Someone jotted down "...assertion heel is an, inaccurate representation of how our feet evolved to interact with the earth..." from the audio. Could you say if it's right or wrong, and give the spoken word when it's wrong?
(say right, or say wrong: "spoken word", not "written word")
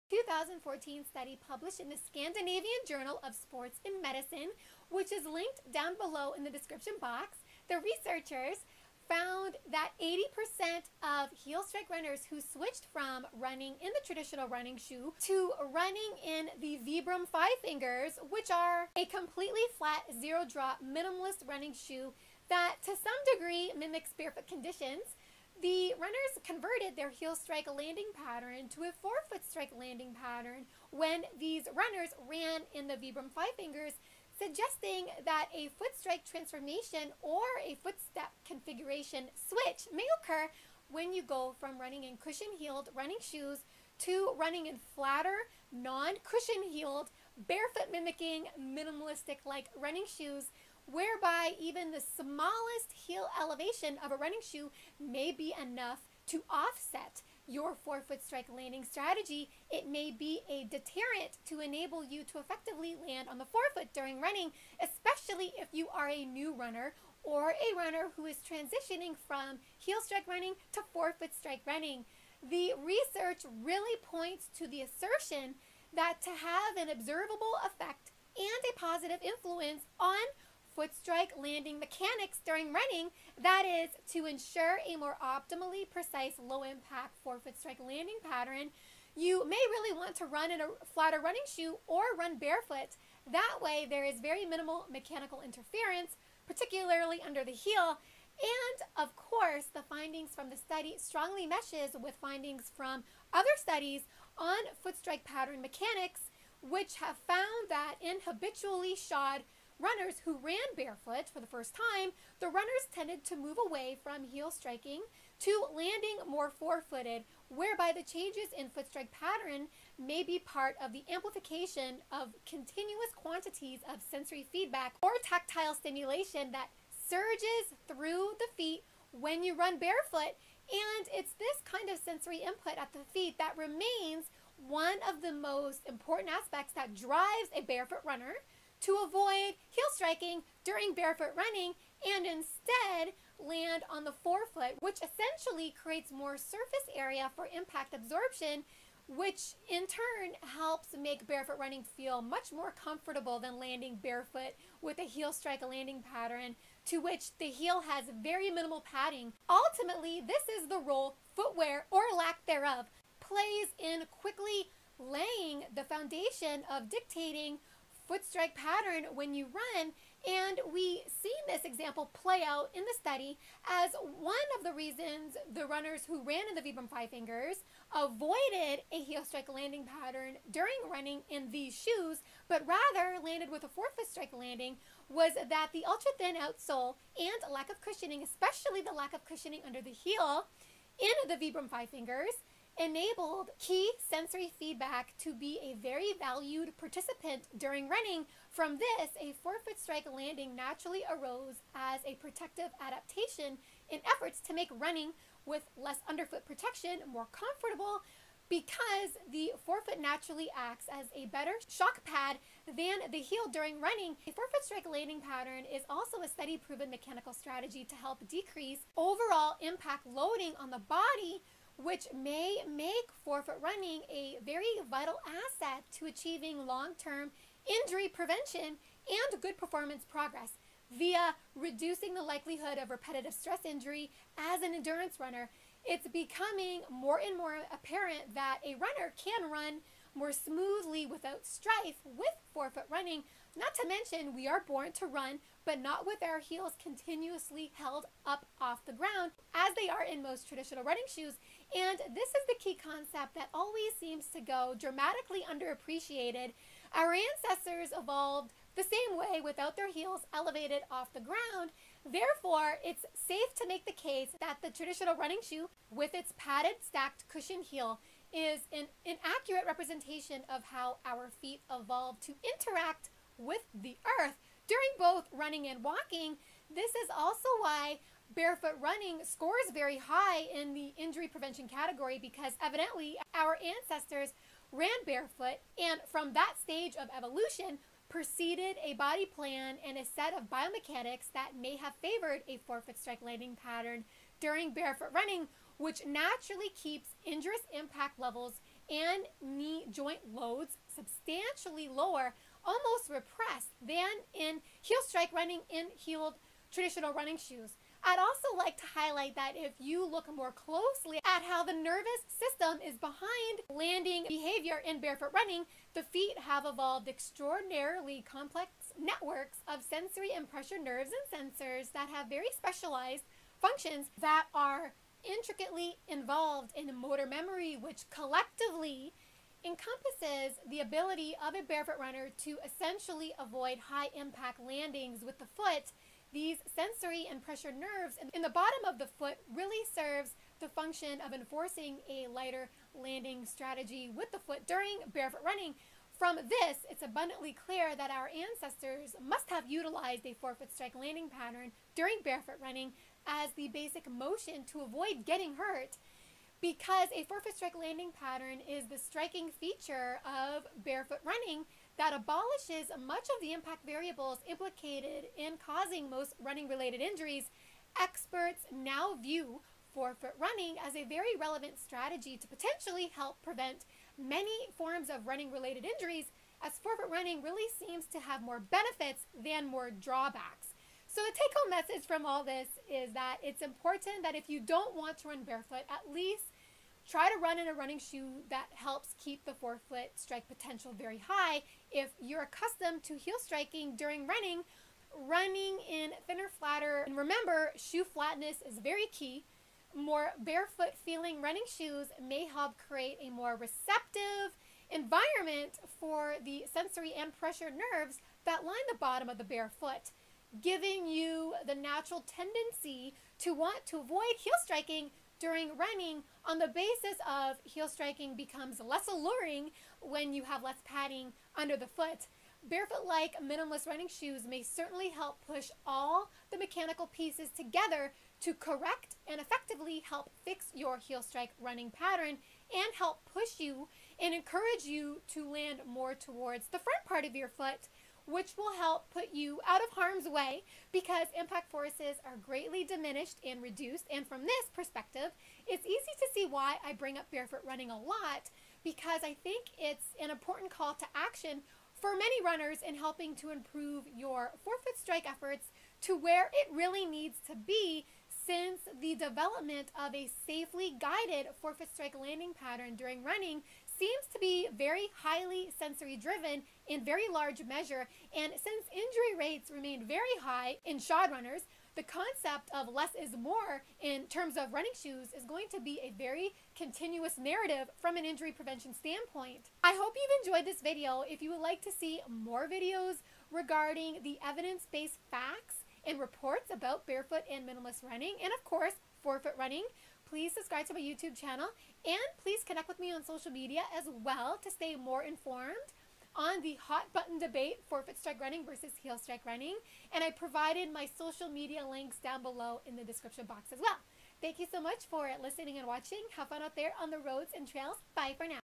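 wrong: "cushion", not "assertion".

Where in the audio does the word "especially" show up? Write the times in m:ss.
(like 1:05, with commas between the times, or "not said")
1:04, 3:08.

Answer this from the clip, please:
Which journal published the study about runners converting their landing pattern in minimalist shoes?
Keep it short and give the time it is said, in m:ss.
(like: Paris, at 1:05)
Scandinavian Journal of Sports and Medicine, at 0:01.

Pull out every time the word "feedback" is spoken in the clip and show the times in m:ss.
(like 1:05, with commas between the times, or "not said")
2:04, 3:14.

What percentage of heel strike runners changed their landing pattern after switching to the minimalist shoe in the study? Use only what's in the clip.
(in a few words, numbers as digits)
80%.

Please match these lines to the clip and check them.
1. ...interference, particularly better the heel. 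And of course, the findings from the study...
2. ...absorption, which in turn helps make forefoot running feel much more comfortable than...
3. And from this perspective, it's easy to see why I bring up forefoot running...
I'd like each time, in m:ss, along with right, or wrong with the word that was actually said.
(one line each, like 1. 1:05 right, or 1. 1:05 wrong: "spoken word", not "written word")
1. 1:35 wrong: "under", not "better"
2. 2:27 wrong: "barefoot", not "forefoot"
3. 7:24 wrong: "barefoot", not "forefoot".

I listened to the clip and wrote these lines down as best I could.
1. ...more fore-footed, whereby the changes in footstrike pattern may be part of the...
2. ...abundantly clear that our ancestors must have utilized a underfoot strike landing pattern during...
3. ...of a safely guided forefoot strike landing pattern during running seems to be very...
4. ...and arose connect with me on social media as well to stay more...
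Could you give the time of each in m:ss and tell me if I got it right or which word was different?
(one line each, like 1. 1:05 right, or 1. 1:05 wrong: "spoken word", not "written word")
1. 1:56 right
2. 5:47 wrong: "forefoot", not "underfoot"
3. 7:39 right
4. 8:12 wrong: "please", not "arose".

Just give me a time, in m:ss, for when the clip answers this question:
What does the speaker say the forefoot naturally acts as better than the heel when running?
3:31.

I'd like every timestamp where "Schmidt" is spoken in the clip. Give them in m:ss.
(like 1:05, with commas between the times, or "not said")
not said.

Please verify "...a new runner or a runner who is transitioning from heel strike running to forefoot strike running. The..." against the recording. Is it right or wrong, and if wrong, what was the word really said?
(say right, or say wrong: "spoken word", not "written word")
right.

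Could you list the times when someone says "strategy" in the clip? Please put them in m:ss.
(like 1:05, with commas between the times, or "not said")
0:58, 3:37, 5:43, 6:11.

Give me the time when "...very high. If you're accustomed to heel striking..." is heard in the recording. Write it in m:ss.
6:30.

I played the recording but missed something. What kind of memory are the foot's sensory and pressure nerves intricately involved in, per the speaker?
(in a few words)
motor memory.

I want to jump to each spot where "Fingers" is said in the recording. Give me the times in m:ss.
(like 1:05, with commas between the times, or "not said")
0:17, 0:33, 2:57, 3:11.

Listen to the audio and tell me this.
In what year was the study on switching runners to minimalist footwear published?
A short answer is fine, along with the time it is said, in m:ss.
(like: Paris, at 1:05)
2014, at 0:00.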